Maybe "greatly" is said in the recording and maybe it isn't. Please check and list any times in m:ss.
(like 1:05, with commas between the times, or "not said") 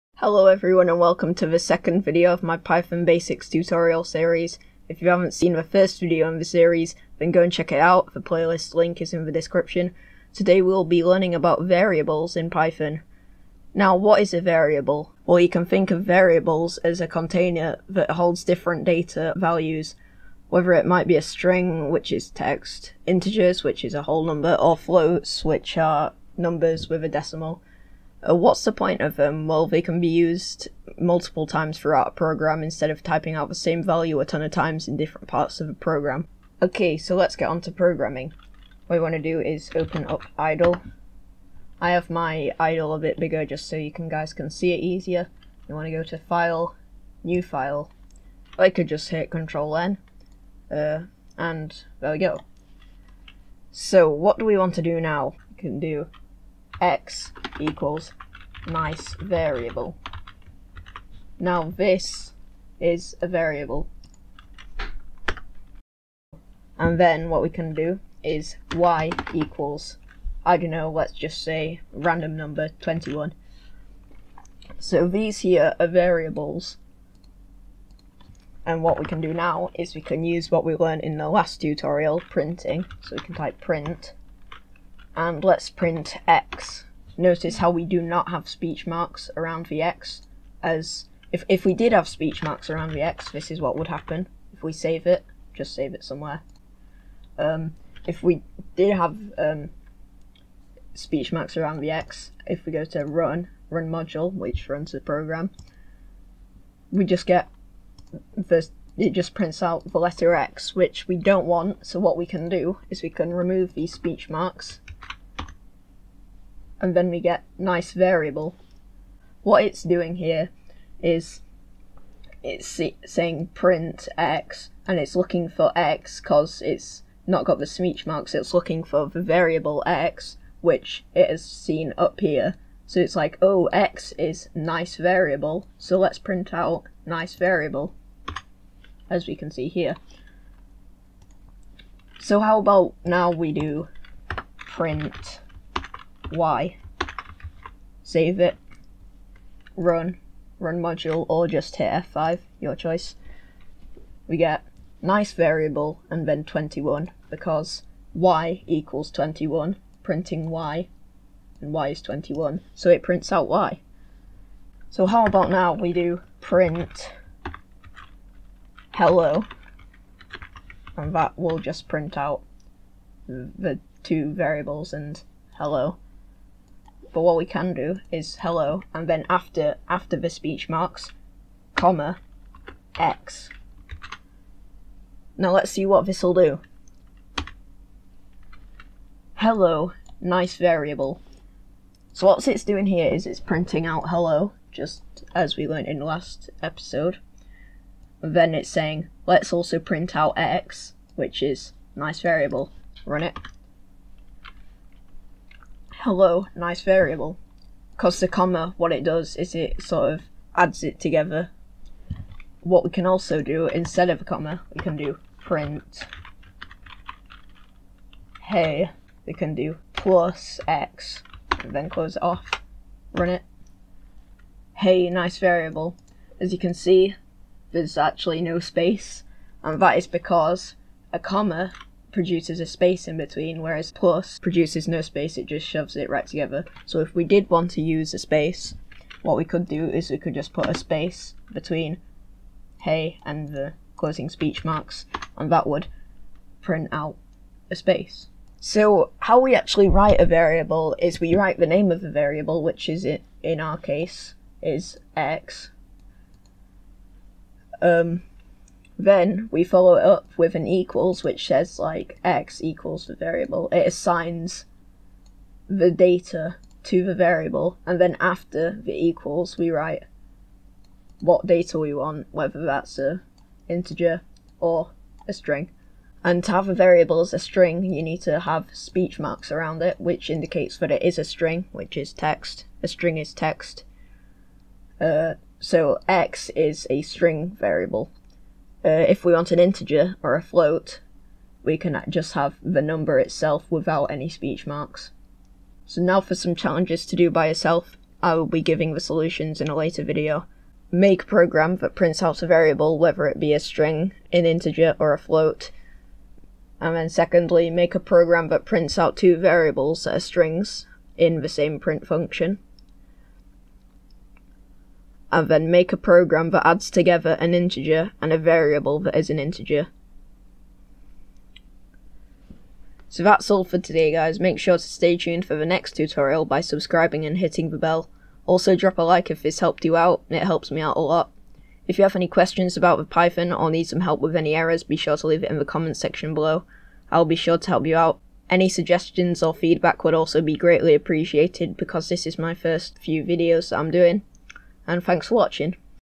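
5:40.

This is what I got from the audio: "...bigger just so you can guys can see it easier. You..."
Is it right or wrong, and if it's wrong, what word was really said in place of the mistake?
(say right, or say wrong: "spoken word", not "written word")
right.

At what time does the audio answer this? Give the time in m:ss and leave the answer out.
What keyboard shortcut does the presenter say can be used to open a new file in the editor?
0:49.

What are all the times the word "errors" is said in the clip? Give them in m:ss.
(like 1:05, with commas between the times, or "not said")
5:34.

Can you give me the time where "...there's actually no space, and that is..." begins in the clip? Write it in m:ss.
3:47.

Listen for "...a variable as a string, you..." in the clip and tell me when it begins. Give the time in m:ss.
4:36.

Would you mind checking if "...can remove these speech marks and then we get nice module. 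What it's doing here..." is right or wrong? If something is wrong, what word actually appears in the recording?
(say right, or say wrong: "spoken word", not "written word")
wrong: "variable", not "module".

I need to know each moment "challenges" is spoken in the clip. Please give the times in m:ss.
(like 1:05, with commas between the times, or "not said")
4:56.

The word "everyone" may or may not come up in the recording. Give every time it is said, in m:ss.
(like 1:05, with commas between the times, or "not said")
0:00.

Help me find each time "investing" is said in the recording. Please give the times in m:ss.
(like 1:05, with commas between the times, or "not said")
not said.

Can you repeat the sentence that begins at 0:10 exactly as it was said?
Today we'll be learning about variables in Python.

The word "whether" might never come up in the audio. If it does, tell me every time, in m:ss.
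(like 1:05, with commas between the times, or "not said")
0:20, 4:32, 5:02.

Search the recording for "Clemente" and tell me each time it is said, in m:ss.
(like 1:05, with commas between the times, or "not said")
not said.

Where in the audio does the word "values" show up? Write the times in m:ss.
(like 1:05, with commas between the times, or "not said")
0:19, 0:33.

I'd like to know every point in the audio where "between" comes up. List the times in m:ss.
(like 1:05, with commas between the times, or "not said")
3:53, 4:01.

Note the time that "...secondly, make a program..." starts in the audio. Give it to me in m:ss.
5:07.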